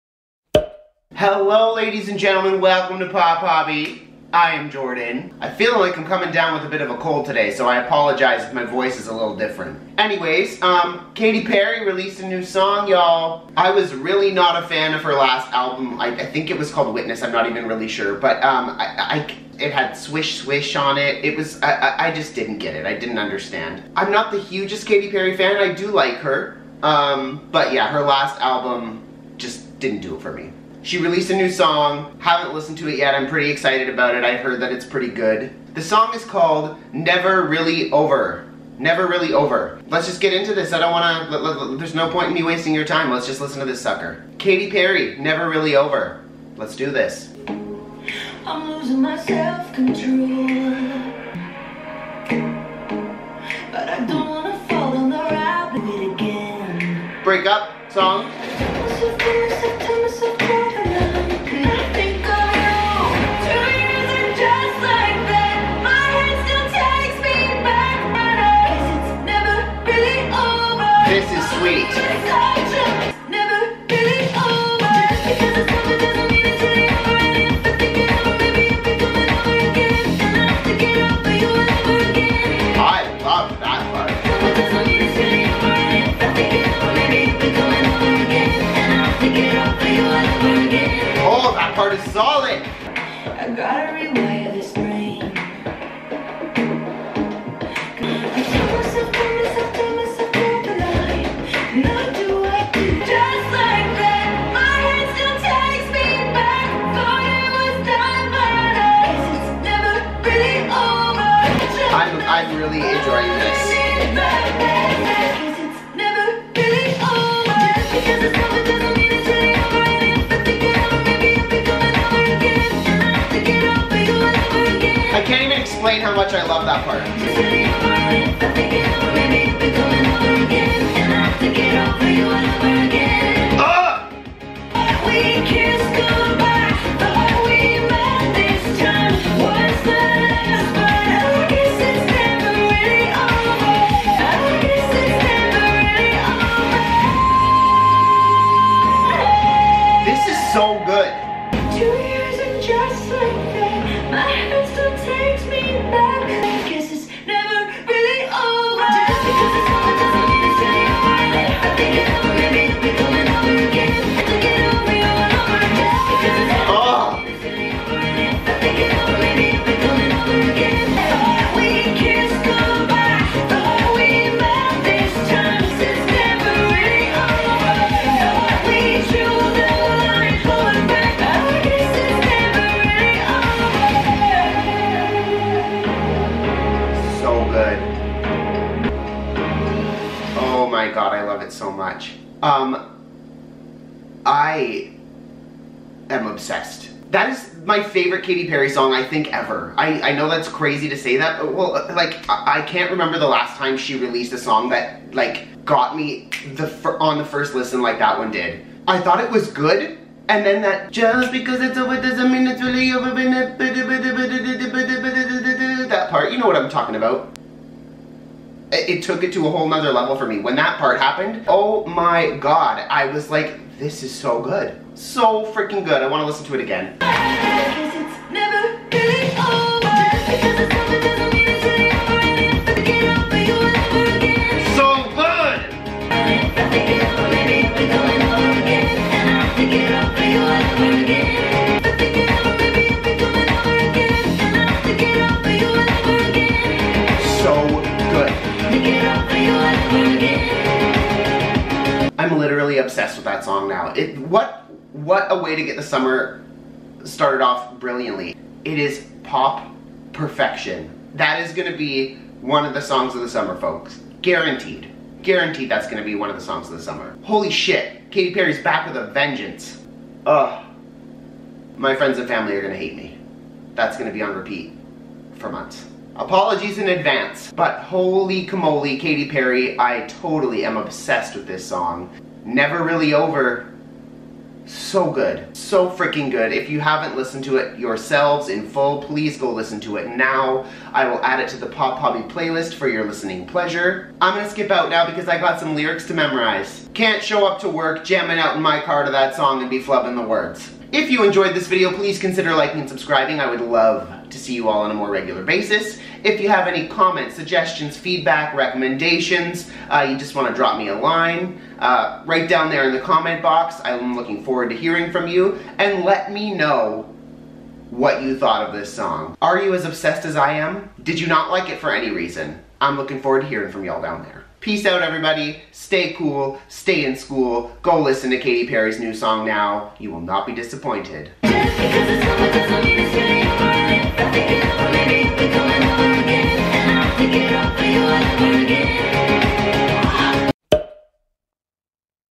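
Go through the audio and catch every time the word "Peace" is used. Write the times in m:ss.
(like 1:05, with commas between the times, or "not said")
5:24.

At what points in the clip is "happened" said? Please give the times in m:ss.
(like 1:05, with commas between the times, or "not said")
3:40.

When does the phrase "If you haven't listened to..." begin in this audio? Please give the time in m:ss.
4:46.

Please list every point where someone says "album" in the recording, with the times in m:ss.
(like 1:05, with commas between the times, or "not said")
0:15, 0:28.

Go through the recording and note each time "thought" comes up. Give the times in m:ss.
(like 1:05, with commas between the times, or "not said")
3:29, 5:18.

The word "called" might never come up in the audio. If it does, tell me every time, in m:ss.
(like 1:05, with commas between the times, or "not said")
0:16, 0:36.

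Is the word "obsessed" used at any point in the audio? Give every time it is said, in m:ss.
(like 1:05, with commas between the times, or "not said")
3:16, 4:12, 4:40, 5:19.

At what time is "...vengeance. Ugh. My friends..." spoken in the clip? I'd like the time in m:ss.
4:29.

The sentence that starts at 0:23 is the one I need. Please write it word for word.
I'm not the hugest Katy Perry fan.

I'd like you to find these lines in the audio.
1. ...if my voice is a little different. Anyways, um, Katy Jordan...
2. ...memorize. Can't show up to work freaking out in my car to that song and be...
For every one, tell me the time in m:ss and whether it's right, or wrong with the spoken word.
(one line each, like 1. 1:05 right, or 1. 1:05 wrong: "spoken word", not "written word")
1. 0:08 wrong: "Perry", not "Jordan"
2. 4:56 wrong: "jamming", not "freaking".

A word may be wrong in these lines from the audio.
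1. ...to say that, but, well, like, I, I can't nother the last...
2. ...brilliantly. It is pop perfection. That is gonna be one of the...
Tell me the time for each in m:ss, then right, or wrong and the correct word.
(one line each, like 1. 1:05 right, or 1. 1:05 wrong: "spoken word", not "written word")
1. 3:20 wrong: "remember", not "nother"
2. 4:17 right.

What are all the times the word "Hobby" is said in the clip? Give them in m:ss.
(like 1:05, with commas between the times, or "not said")
0:03, 4:51.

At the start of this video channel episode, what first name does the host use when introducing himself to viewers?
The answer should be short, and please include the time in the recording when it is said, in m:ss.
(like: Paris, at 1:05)
Jordan, at 0:04.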